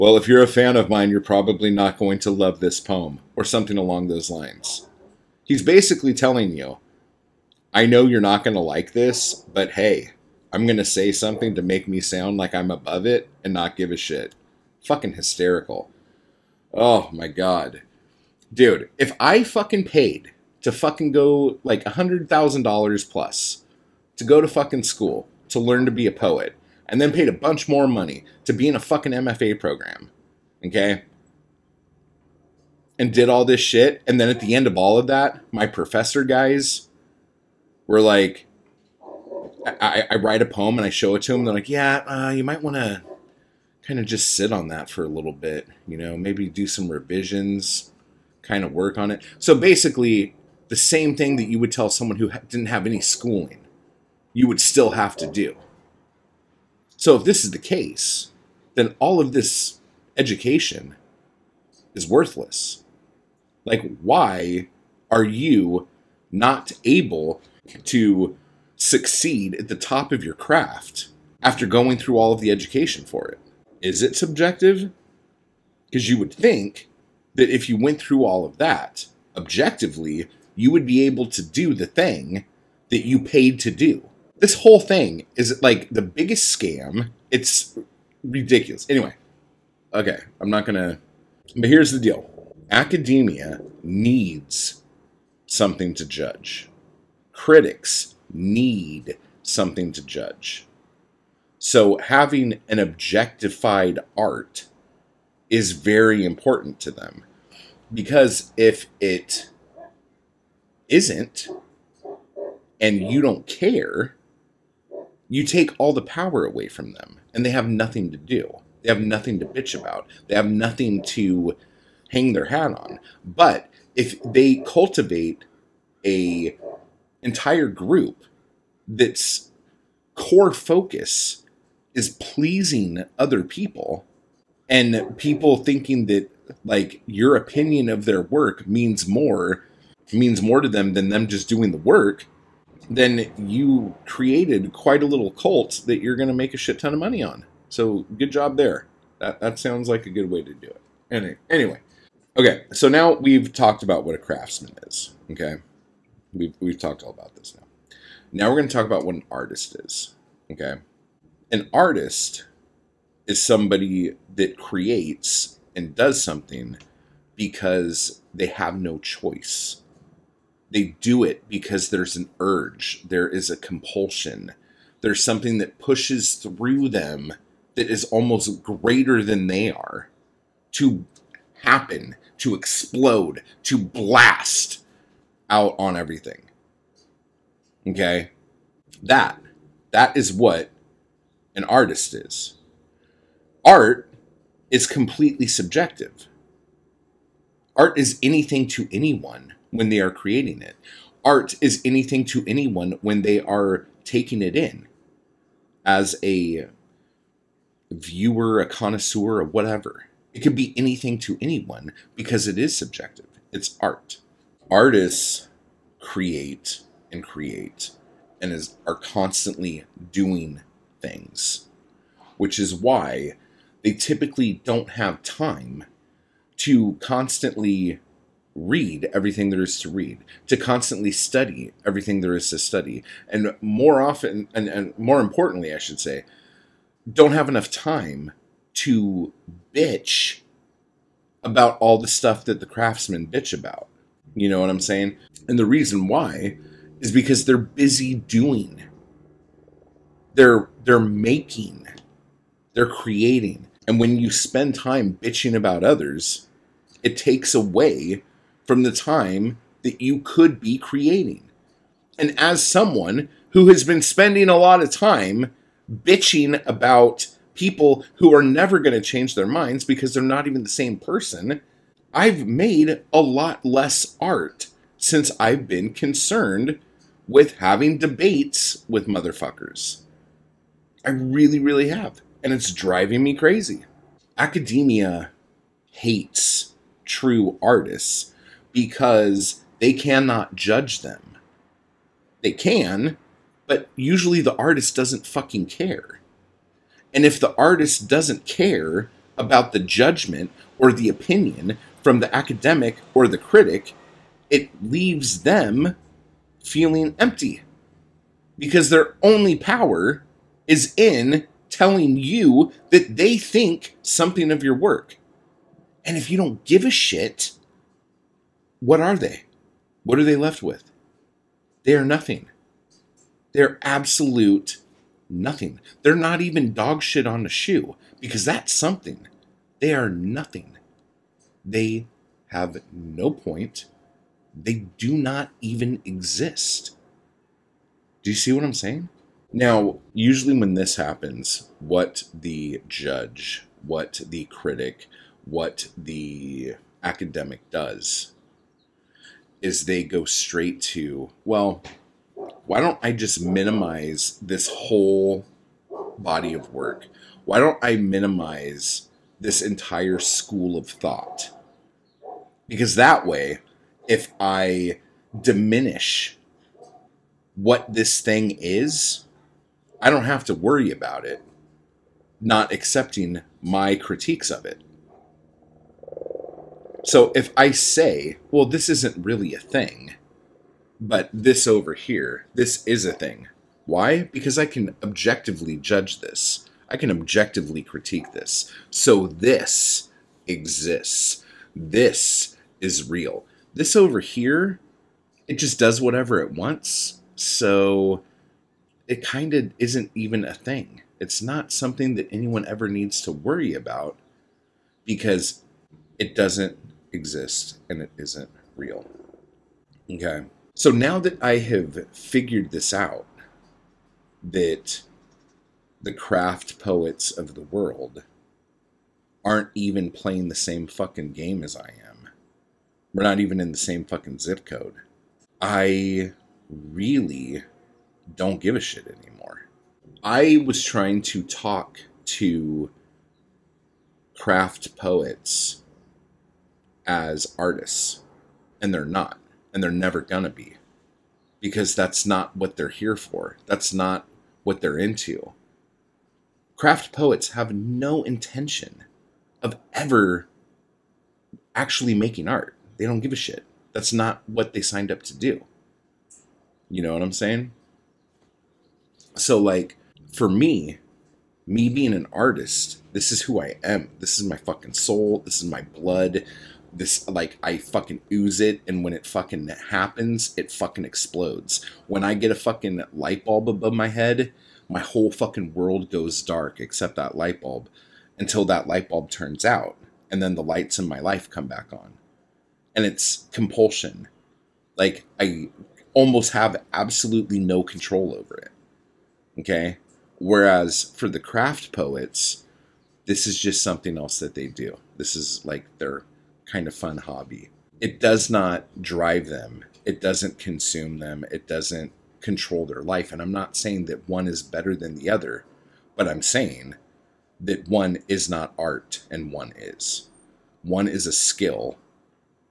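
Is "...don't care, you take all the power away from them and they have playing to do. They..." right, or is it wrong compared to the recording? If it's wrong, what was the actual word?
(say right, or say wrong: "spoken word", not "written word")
wrong: "nothing", not "playing".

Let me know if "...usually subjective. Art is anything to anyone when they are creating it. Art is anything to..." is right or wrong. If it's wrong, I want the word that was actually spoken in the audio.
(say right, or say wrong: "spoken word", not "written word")
wrong: "completely", not "usually".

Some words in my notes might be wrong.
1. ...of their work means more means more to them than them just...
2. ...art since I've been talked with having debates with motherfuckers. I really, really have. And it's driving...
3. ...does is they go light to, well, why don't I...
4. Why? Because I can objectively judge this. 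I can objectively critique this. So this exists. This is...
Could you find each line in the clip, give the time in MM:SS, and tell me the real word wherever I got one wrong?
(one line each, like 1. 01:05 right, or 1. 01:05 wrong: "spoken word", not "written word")
1. 02:17 right
2. 04:34 wrong: "concerned", not "talked"
3. 05:47 wrong: "straight", not "light"
4. 06:23 right.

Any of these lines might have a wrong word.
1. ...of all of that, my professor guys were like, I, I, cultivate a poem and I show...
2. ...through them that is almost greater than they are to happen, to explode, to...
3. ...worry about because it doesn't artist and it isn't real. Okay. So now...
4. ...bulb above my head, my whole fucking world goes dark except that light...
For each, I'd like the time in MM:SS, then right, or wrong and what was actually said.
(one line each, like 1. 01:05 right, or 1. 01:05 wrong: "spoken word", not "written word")
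1. 00:34 wrong: "write", not "cultivate"
2. 02:56 right
3. 06:43 wrong: "exist", not "artist"
4. 07:53 right.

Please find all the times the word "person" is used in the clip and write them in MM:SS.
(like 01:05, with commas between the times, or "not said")
04:30.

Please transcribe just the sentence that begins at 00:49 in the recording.
So basically, the same thing that you would tell someone who didn't have any schooling, you would still have to do.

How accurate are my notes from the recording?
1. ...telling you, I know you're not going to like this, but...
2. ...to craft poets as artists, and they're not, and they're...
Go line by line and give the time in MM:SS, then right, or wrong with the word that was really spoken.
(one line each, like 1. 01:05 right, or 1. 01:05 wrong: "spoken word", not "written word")
1. 00:06 right
2. 07:12 right.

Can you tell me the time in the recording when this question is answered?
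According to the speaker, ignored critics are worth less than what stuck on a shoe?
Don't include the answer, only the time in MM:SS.
05:26.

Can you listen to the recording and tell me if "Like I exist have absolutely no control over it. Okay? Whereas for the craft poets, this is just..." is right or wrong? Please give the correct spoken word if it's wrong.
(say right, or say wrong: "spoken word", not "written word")
wrong: "almost", not "exist".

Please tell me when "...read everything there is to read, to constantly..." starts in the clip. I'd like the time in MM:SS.
03:48.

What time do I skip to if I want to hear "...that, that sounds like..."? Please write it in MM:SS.
02:29.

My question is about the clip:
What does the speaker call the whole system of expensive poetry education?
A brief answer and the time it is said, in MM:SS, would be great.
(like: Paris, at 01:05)
scam, at 01:25.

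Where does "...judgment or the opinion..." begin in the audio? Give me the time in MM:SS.
04:59.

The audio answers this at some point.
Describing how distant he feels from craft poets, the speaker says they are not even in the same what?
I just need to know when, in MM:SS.
07:04.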